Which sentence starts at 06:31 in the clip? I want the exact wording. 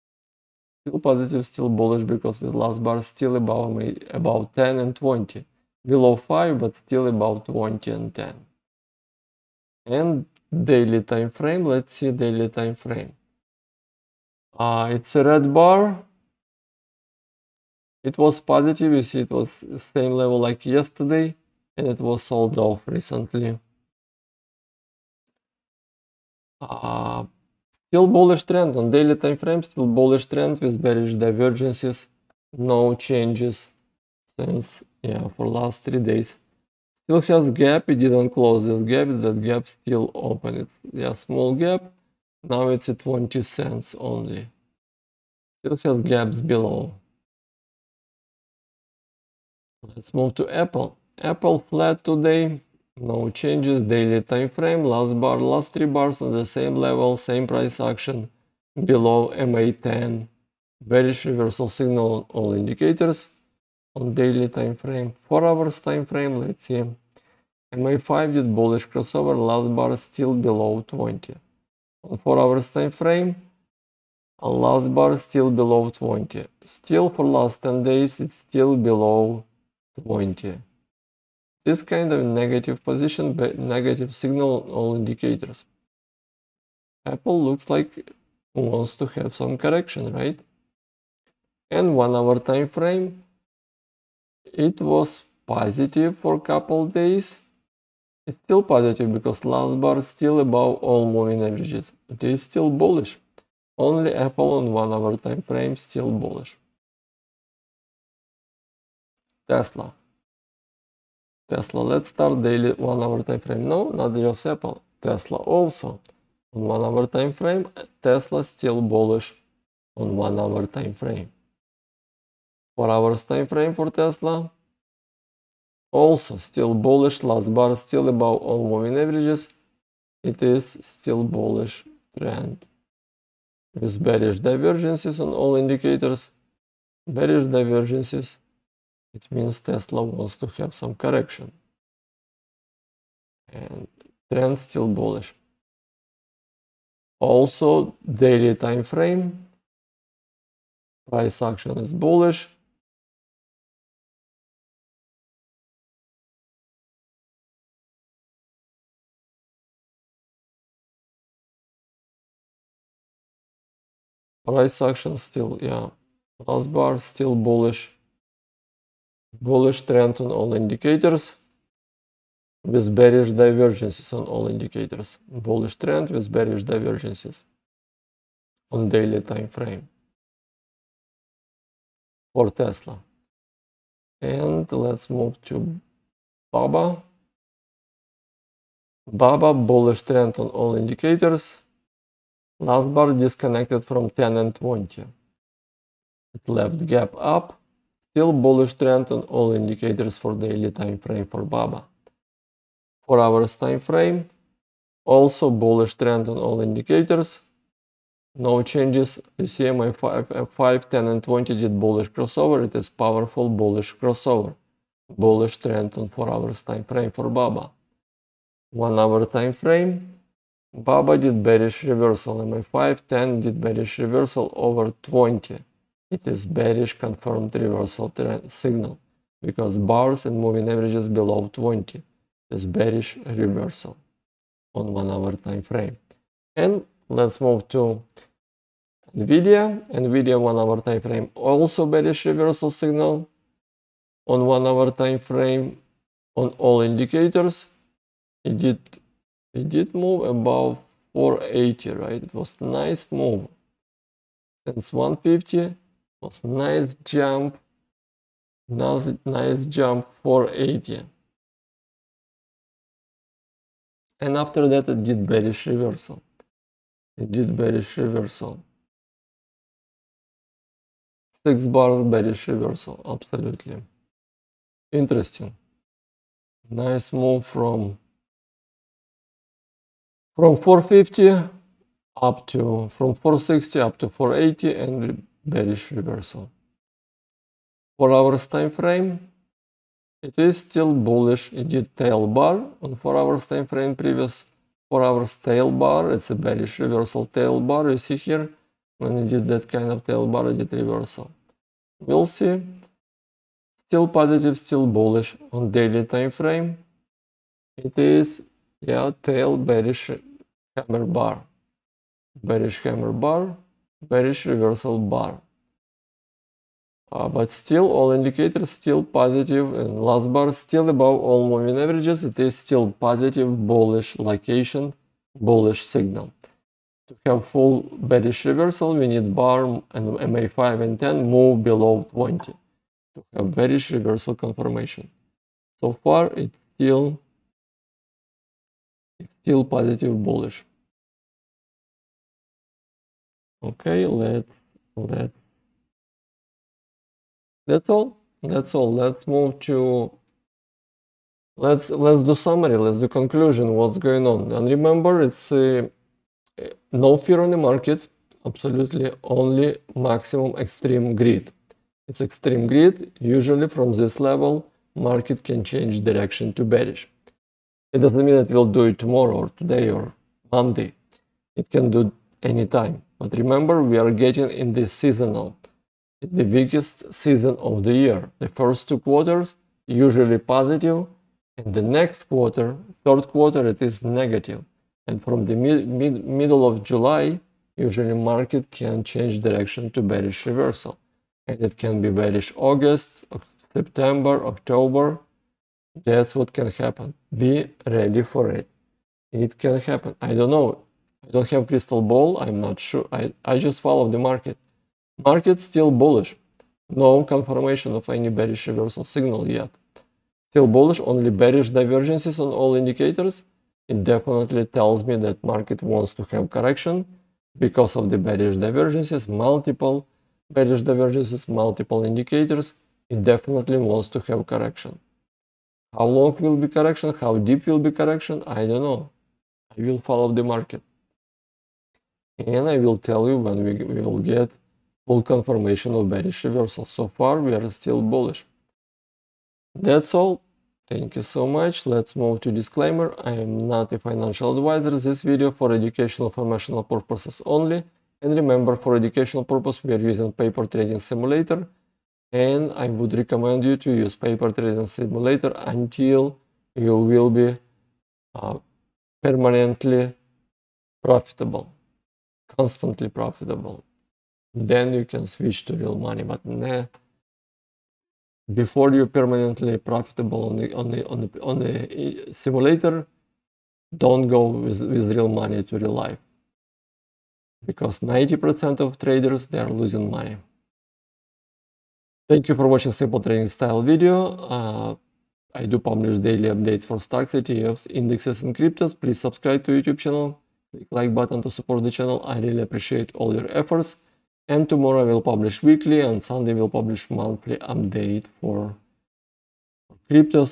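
And it can be bearish August, September, October.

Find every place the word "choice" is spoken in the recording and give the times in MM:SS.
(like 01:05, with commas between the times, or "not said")
not said.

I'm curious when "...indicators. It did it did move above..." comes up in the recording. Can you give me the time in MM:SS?
04:06.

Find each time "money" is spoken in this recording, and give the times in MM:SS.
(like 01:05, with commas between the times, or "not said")
07:45, 07:55, 08:00.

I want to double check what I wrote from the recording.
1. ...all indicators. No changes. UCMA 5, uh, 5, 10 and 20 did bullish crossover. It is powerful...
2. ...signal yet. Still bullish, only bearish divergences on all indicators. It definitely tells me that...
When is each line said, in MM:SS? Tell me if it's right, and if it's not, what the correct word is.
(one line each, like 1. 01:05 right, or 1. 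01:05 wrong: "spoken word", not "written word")
1. 03:26 right
2. 06:49 right.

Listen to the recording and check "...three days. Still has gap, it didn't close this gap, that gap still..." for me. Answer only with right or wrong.
right.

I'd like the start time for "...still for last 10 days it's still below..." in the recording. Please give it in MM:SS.
01:16.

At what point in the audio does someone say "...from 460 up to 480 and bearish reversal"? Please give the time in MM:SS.
04:42.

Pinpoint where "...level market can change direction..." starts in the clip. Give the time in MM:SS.
06:04.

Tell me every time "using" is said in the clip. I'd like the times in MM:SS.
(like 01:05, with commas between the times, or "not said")
07:29.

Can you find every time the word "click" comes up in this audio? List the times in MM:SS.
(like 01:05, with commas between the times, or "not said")
08:10.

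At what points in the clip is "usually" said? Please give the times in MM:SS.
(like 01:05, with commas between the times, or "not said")
06:03, 06:19, 06:27.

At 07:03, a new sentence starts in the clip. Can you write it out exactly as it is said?
It definitely wants to have correction.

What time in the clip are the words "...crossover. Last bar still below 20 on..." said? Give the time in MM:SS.
01:08.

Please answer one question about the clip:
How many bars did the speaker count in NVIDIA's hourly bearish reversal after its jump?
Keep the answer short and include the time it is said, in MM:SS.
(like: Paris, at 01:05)
6, at 04:31.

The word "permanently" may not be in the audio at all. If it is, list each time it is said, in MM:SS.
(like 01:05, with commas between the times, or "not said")
07:39, 07:49.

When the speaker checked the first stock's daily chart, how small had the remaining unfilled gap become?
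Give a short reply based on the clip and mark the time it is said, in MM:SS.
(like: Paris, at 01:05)
20 cents, at 00:42.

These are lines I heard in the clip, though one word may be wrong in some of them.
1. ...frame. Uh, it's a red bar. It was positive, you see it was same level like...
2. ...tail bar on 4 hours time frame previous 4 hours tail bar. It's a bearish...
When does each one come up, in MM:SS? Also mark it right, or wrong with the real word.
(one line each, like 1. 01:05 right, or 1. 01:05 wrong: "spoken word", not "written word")
1. 00:12 right
2. 04:51 right.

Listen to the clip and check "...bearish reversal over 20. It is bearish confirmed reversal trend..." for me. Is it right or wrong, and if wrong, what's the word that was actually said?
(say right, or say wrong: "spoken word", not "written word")
right.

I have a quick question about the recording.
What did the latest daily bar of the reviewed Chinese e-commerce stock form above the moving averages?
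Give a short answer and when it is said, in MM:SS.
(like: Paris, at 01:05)
gap up, at 03:16.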